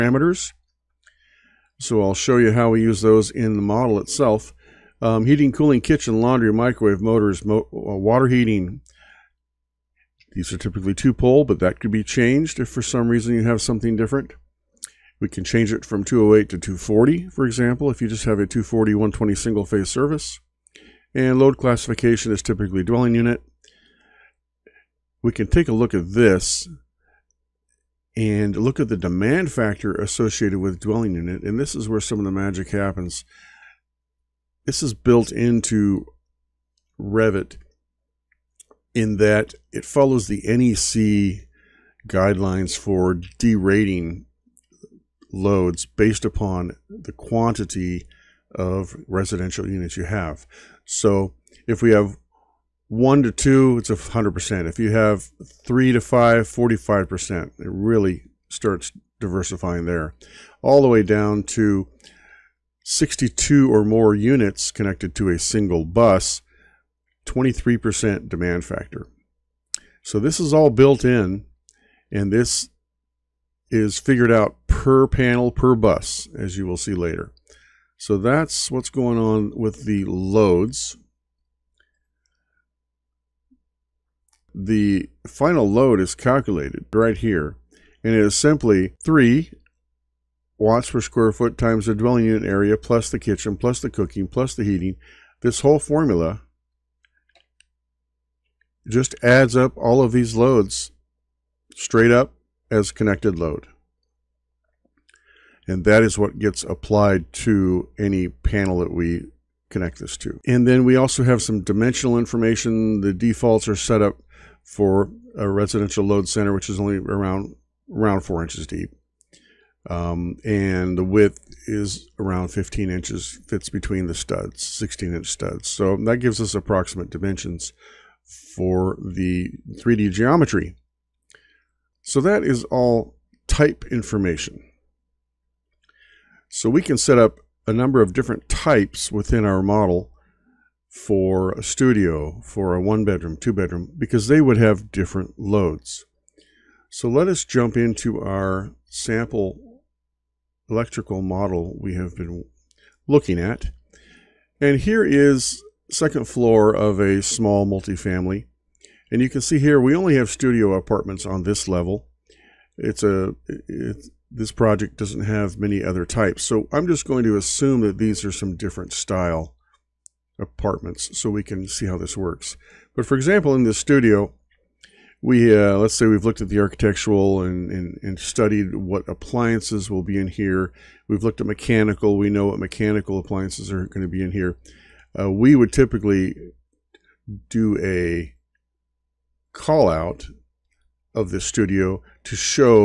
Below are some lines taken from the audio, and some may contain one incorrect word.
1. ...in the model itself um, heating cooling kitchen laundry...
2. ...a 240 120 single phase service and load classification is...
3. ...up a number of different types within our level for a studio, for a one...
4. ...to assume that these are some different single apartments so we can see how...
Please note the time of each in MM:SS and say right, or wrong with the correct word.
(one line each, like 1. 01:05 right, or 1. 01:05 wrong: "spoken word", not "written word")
1. 00:03 right
2. 00:18 right
3. 02:17 wrong: "model", not "level"
4. 02:47 wrong: "style", not "single".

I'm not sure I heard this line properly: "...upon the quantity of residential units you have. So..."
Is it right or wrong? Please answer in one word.
right.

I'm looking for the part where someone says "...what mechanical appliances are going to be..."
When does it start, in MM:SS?
03:02.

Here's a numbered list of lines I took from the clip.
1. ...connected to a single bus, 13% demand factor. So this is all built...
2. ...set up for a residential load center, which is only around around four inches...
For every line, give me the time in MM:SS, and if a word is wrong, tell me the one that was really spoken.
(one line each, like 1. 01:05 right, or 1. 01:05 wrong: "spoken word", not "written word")
1. 01:04 wrong: "23", not "13"
2. 01:53 right.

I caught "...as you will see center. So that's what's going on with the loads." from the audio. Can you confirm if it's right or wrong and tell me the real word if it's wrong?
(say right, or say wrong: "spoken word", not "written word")
wrong: "later", not "center".